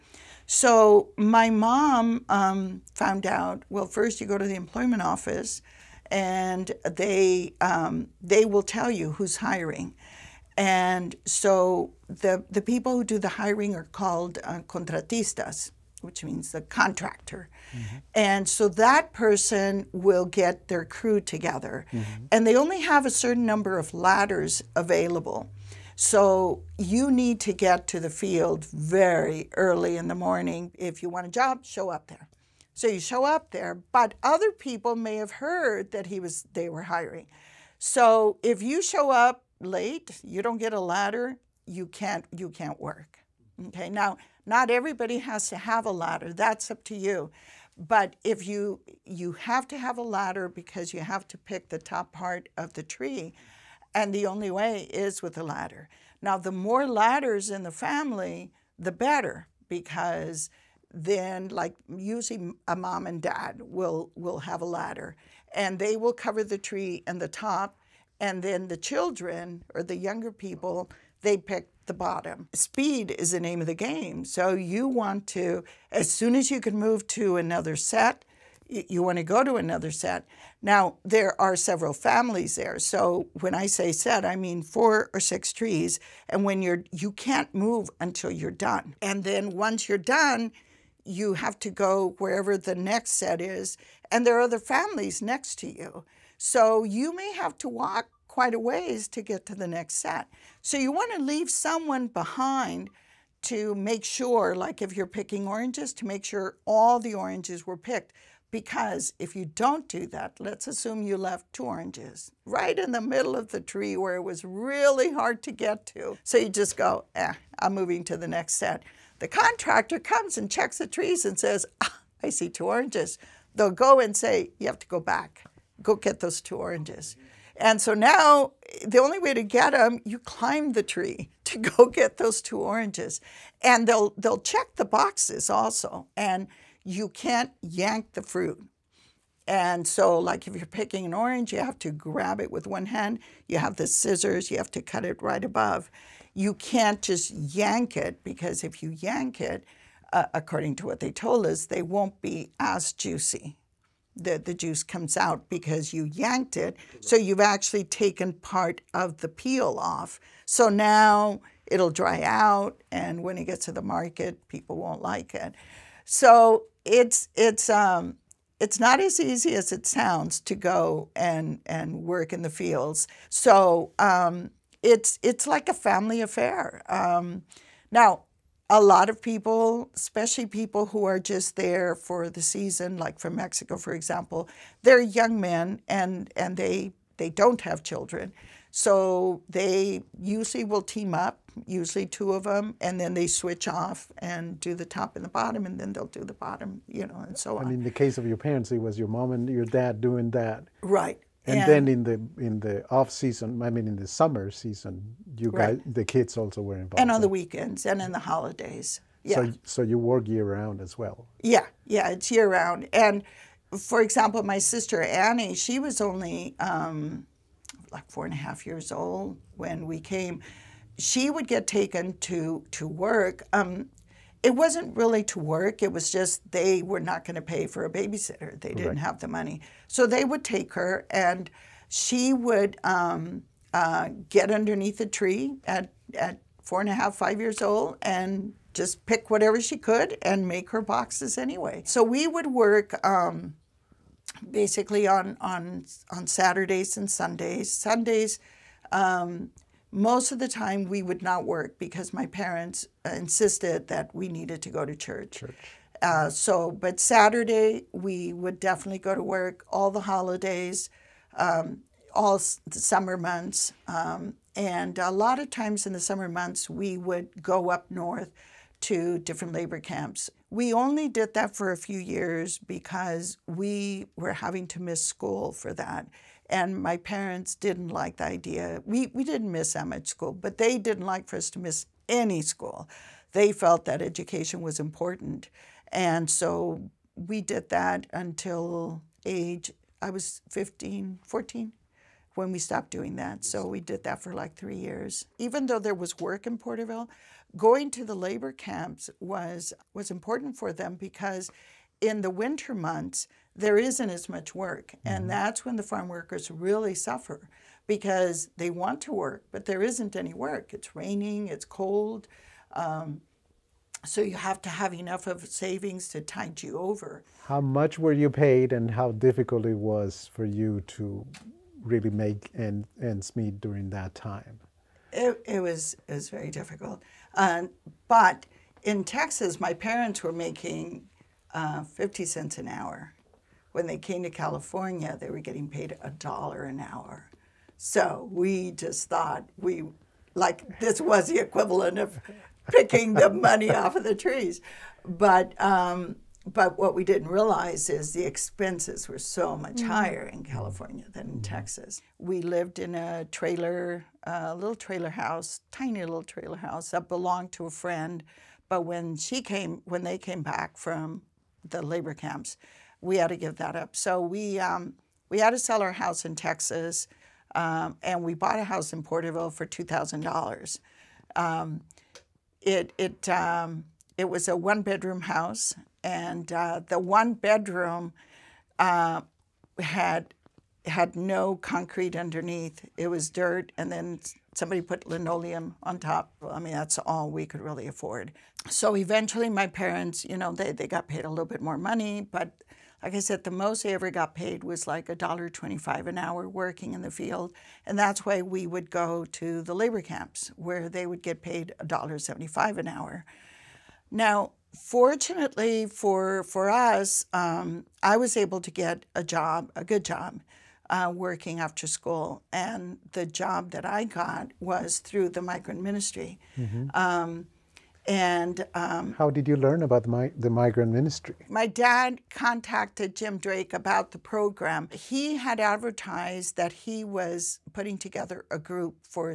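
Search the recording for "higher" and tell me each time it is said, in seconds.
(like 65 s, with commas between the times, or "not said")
349 s.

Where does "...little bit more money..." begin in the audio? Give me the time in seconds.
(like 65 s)
391 s.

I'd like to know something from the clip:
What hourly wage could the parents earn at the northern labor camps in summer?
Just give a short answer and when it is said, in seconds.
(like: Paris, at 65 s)
$1.75, at 401 s.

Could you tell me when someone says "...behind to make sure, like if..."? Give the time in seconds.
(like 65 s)
102 s.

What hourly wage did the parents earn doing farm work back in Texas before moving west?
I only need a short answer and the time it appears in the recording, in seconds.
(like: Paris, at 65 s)
50 cents, at 331 s.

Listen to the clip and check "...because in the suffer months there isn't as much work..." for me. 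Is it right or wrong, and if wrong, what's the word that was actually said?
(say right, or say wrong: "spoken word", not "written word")
wrong: "winter", not "suffer".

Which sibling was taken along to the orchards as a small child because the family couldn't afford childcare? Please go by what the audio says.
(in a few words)
Annie.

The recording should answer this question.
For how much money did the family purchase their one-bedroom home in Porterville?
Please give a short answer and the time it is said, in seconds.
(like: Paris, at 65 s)
$2,000, at 369 s.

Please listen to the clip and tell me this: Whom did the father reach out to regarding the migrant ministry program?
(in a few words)
Jim Drake.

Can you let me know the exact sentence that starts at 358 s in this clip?
But when she came, when they came back from the labor camps, we had to give that up.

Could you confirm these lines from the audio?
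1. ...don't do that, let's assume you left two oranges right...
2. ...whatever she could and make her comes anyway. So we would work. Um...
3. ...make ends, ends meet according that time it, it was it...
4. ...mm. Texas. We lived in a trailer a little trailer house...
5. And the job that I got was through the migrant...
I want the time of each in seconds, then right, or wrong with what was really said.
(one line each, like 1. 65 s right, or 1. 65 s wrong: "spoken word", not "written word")
1. 109 s right
2. 239 s wrong: "boxes", not "comes"
3. 322 s wrong: "during", not "according"
4. 351 s right
5. 412 s right.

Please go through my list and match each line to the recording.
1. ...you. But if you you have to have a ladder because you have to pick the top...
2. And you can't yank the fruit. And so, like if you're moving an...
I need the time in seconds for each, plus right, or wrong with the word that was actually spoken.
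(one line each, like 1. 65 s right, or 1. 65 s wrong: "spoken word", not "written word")
1. 46 s right
2. 136 s wrong: "picking", not "moving".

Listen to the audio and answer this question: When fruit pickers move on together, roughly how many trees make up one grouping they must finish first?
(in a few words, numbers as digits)
4 or 6 trees.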